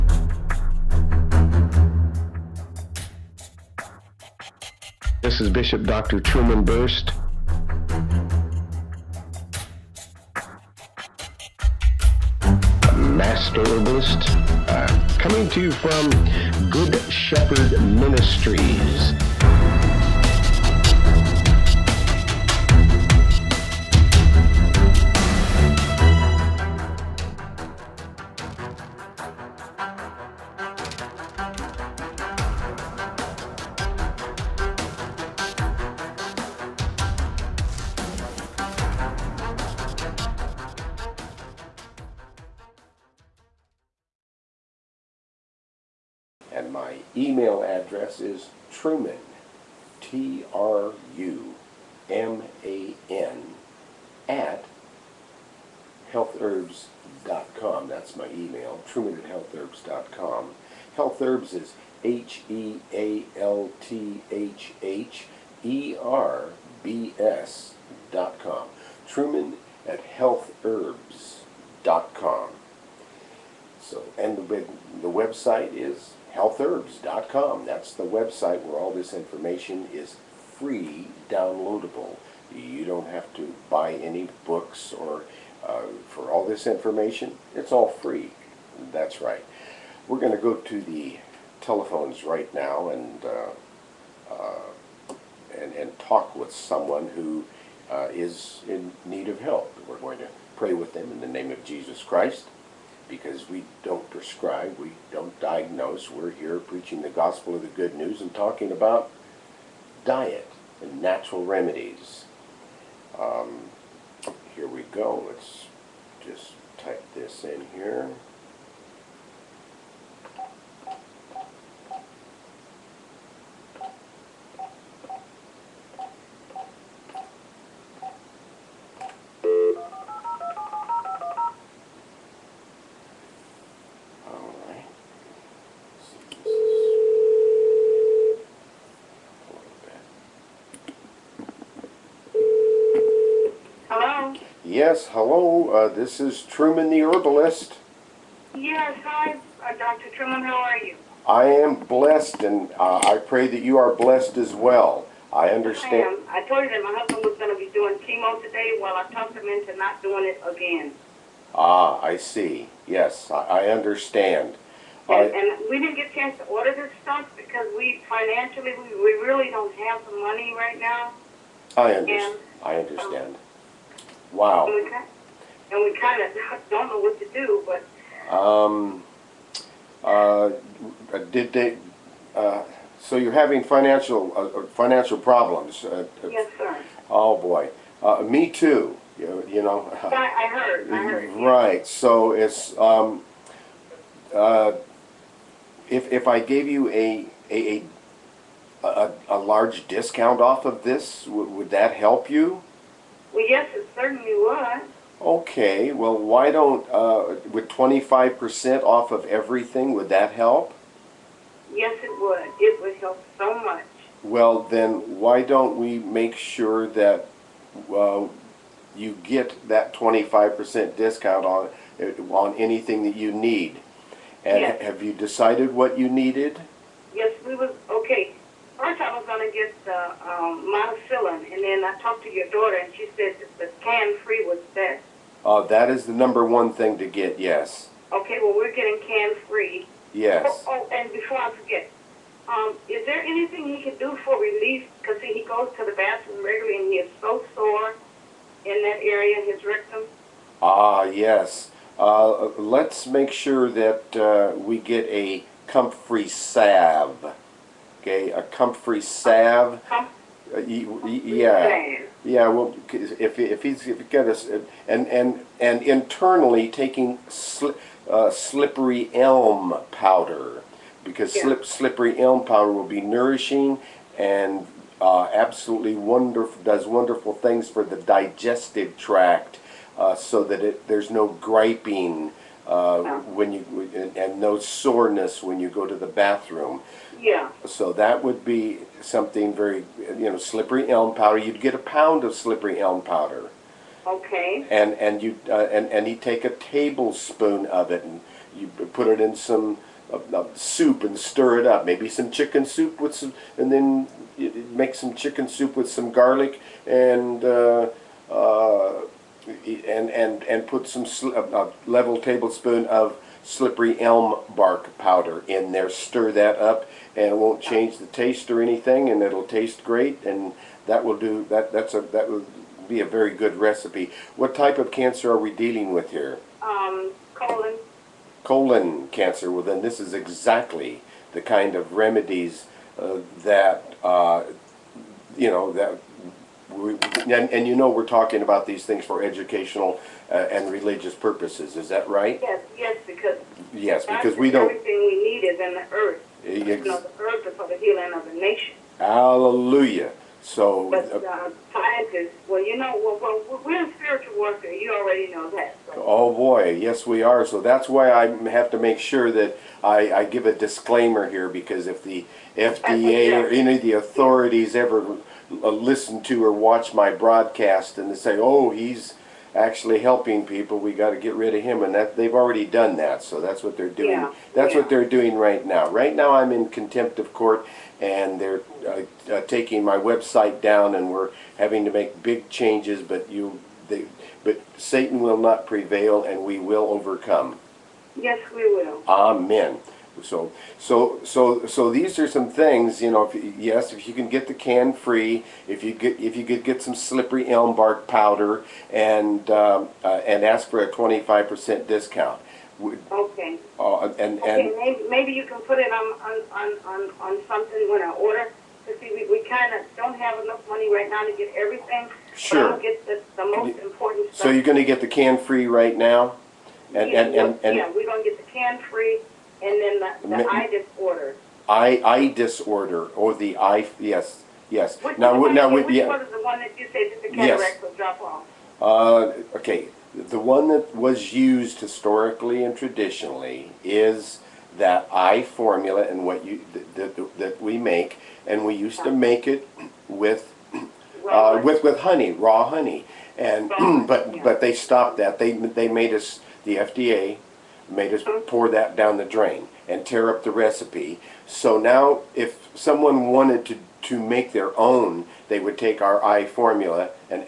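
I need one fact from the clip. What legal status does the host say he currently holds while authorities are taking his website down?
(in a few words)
Contempt of court.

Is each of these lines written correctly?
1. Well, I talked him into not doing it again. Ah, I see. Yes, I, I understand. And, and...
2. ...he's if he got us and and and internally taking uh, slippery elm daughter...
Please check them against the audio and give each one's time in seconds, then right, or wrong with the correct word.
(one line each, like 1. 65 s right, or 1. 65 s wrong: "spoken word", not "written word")
1. 158 s right
2. 263 s wrong: "powder", not "daughter".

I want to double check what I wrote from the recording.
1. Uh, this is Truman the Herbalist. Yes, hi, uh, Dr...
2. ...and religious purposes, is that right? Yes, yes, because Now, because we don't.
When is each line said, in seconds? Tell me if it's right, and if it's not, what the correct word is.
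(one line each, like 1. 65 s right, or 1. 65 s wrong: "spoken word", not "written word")
1. 145 s right
2. 340 s wrong: "Yes", not "Now".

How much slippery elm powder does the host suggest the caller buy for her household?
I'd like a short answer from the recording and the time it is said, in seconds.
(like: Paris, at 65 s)
A pound, at 291 s.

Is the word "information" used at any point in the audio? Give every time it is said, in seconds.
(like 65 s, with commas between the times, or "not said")
79 s, 86 s.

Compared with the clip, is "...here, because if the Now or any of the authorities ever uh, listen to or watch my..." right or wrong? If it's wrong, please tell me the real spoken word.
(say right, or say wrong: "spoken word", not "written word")
wrong: "FDA", not "Now".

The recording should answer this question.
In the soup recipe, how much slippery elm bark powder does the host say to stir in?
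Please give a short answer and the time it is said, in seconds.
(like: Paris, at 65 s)
A level tablespoon, at 311 s.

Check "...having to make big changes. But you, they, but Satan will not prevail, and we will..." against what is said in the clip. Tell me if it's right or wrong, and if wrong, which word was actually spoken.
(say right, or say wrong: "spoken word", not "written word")
right.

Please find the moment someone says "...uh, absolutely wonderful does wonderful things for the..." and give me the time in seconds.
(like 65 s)
275 s.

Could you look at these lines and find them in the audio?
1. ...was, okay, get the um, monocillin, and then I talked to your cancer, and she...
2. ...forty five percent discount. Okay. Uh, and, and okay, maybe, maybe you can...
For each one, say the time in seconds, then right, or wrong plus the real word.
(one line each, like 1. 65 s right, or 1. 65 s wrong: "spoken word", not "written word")
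1. 227 s wrong: "daughter", not "cancer"
2. 400 s wrong: "twenty", not "forty".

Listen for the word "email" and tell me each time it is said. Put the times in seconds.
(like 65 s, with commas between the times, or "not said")
47 s, 58 s.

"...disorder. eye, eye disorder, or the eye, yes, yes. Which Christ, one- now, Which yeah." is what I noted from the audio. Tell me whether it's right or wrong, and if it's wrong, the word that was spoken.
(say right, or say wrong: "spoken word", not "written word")
wrong: "Now", not "Christ".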